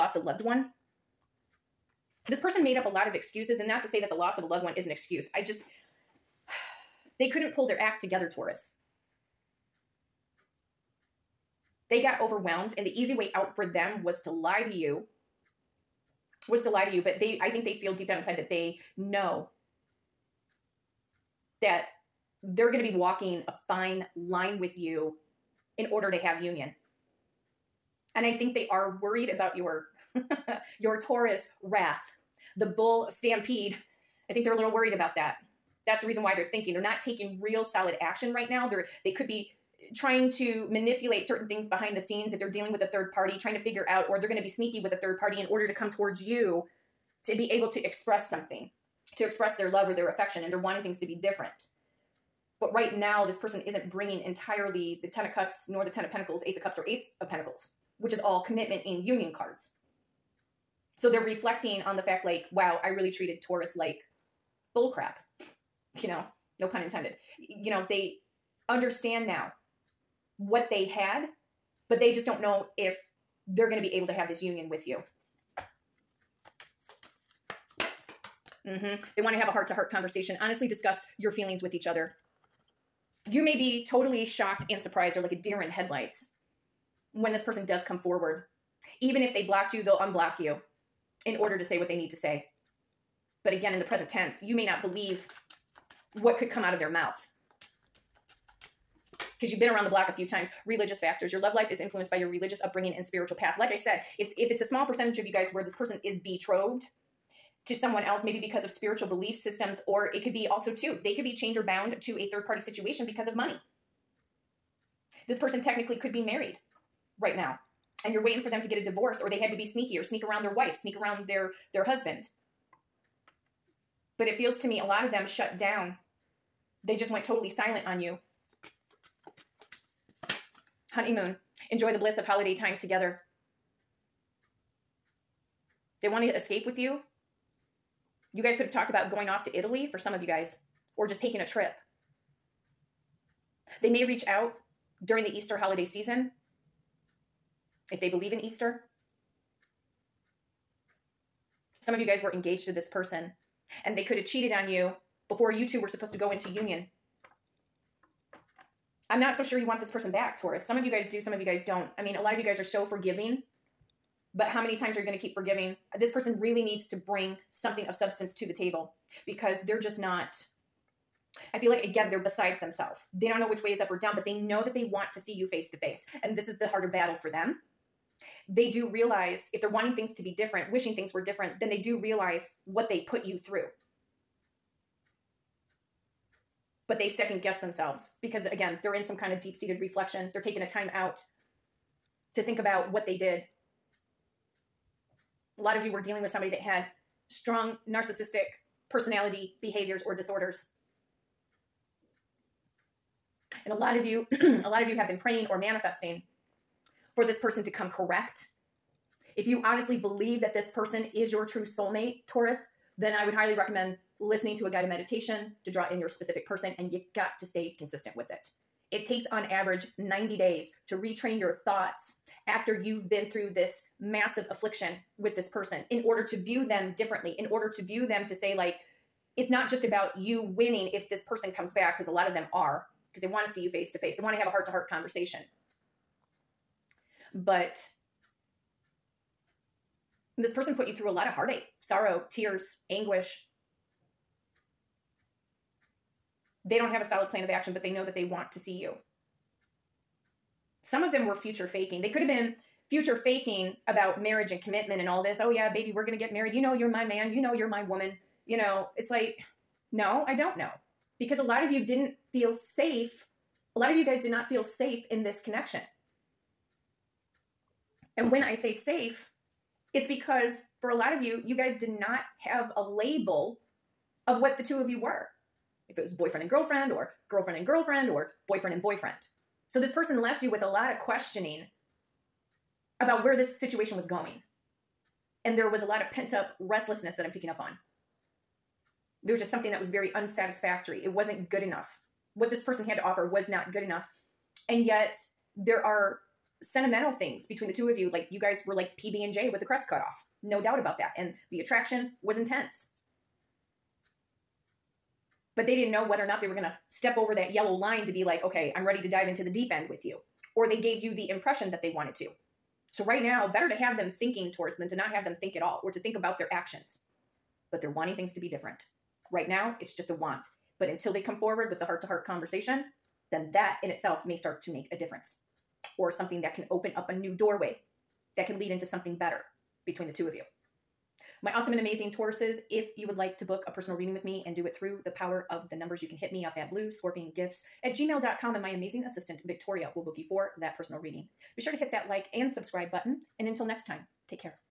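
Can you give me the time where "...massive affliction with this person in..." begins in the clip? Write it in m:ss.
3:43.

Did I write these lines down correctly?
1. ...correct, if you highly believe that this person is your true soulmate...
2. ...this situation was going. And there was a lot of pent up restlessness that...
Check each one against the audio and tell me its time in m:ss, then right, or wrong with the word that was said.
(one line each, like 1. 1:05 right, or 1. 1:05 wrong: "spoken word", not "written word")
1. 3:27 wrong: "honestly", not "highly"
2. 4:43 right.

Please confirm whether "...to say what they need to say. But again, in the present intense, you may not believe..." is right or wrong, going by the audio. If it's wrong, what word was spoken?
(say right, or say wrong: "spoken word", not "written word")
wrong: "tense", not "intense".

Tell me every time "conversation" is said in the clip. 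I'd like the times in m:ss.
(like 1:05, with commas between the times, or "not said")
1:19, 3:54, 5:22.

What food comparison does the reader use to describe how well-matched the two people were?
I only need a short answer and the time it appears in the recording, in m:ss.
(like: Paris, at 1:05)
PB&J, at 4:58.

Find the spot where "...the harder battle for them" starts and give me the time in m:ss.
2:56.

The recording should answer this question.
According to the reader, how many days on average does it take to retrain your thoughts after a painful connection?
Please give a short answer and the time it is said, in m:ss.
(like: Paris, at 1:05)
90, at 3:39.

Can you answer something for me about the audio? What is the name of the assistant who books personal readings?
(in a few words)
Victoria.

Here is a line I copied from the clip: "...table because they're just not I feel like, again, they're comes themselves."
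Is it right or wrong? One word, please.
wrong.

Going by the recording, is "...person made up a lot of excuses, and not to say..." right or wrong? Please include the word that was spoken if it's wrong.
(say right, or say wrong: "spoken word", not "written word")
right.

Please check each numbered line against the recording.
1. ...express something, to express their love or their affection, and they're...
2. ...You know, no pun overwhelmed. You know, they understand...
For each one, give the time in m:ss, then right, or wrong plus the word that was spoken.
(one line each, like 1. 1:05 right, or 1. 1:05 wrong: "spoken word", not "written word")
1. 0:47 right
2. 1:06 wrong: "intended", not "overwhelmed".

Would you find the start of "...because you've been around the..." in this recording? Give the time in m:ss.
1:39.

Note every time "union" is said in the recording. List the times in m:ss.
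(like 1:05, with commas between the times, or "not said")
0:26, 0:59, 1:14, 2:36.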